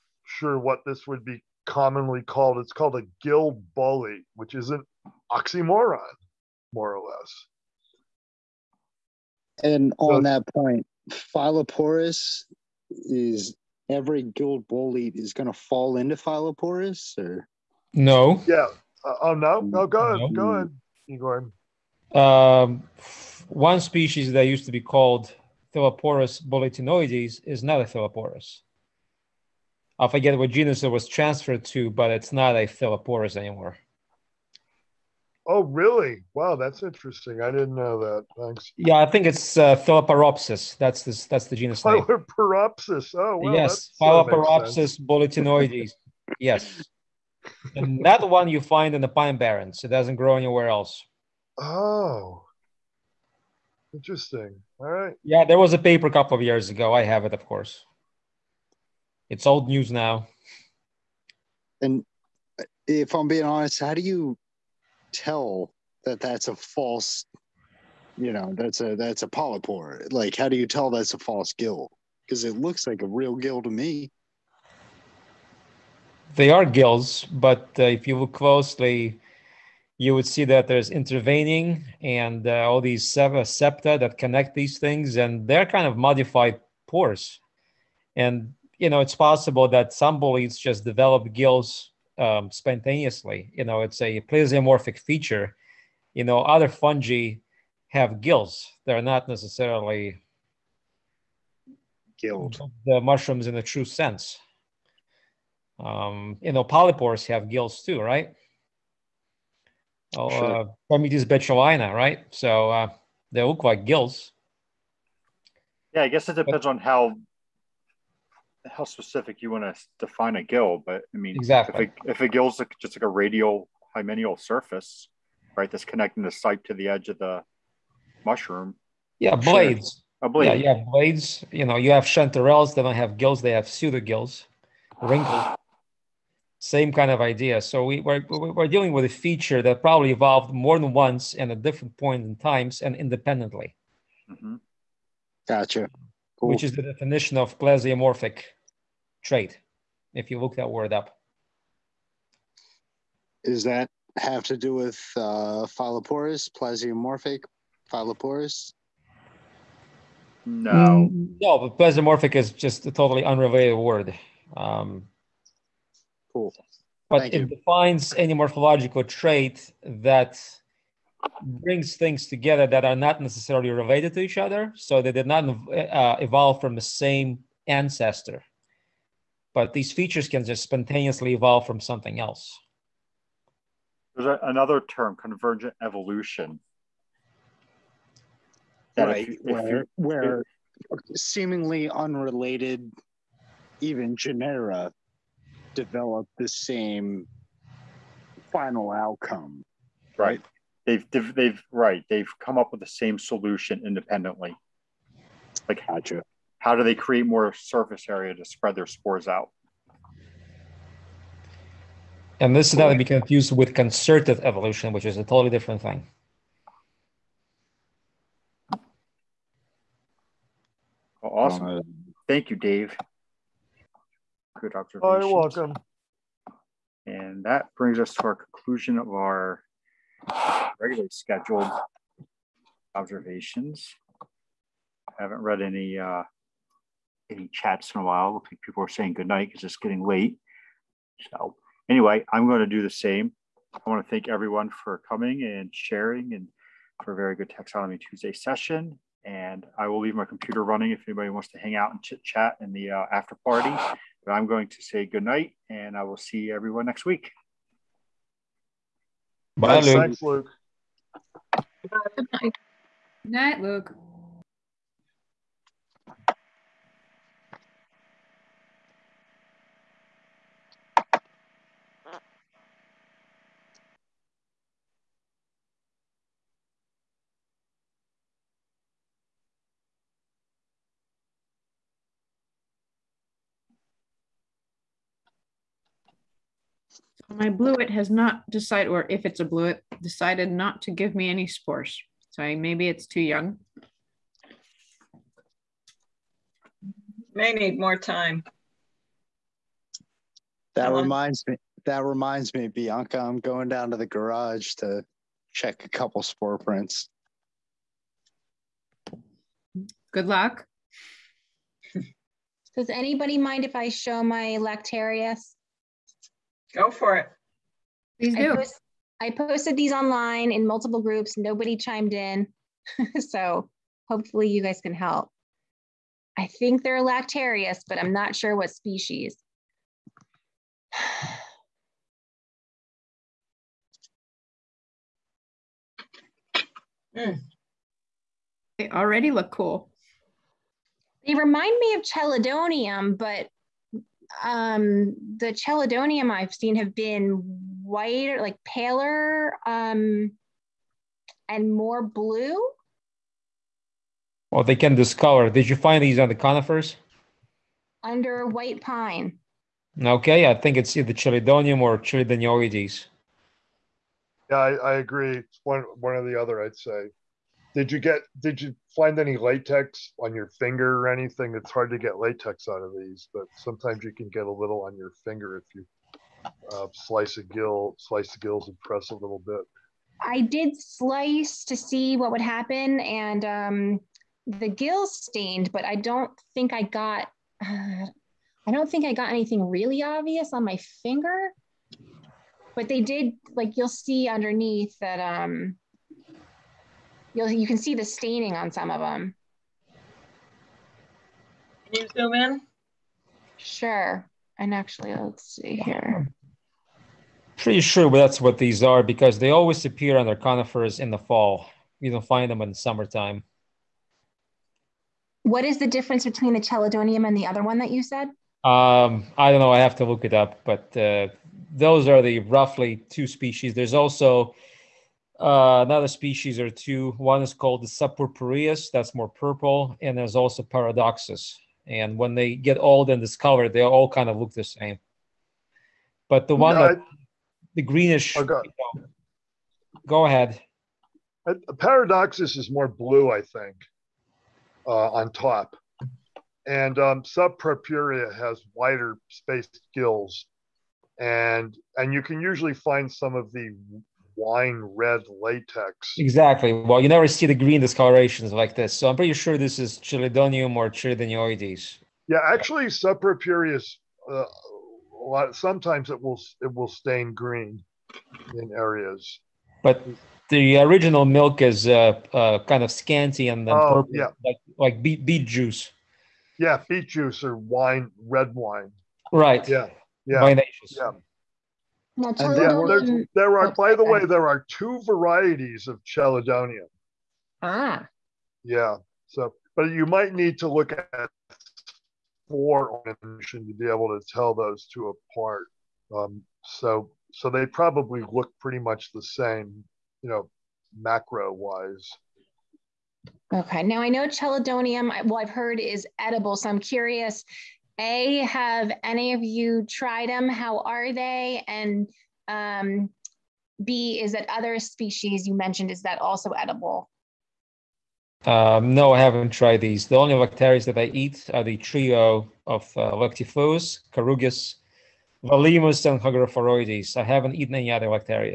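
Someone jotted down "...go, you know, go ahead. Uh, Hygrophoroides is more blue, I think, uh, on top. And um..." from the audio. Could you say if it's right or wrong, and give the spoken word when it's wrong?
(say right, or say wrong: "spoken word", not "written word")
wrong: "Paradoxus", not "Hygrophoroides".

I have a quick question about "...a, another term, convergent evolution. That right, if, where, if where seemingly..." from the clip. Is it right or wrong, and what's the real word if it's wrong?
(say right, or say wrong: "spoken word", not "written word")
right.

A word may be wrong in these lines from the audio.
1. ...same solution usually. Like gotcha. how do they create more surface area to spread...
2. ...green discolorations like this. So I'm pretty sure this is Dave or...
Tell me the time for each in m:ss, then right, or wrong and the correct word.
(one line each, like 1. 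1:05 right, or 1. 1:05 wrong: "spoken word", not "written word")
1. 3:22 wrong: "independently", not "usually"
2. 7:37 wrong: "Chelidonium", not "Dave".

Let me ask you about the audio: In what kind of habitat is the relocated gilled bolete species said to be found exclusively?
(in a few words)
the pine barrens.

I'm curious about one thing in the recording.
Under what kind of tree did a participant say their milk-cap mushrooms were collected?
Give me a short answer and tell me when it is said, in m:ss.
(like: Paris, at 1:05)
white pine, at 5:58.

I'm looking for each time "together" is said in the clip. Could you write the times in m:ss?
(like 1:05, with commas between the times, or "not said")
2:52.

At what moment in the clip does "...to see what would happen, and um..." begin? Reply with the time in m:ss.
6:21.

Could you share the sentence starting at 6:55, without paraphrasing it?
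What is the difference between the chelidonium and the other one that you said?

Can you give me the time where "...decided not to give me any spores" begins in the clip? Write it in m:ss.
4:50.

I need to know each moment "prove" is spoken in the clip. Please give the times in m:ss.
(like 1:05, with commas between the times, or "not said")
not said.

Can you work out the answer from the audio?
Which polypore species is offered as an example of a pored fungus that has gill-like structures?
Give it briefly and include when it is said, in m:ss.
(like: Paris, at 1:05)
Trametes betulina, at 1:50.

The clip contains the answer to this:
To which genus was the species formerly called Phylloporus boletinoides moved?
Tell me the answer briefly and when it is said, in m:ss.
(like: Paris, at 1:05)
Phylloporopsis, at 0:44.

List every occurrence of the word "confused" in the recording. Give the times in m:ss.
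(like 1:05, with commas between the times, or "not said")
3:33.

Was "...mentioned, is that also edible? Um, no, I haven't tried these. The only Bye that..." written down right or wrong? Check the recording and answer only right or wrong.
wrong.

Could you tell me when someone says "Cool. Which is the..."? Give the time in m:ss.
2:26.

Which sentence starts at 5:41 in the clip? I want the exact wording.
They remind me of Chelidonium, but um, the chelidonium I've seen have been whiter, like paler um, and more blue.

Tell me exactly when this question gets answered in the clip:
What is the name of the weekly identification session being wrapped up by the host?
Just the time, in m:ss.
4:07.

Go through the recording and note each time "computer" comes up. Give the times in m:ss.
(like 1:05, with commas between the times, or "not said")
4:10.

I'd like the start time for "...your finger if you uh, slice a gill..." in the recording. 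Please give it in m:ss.
6:14.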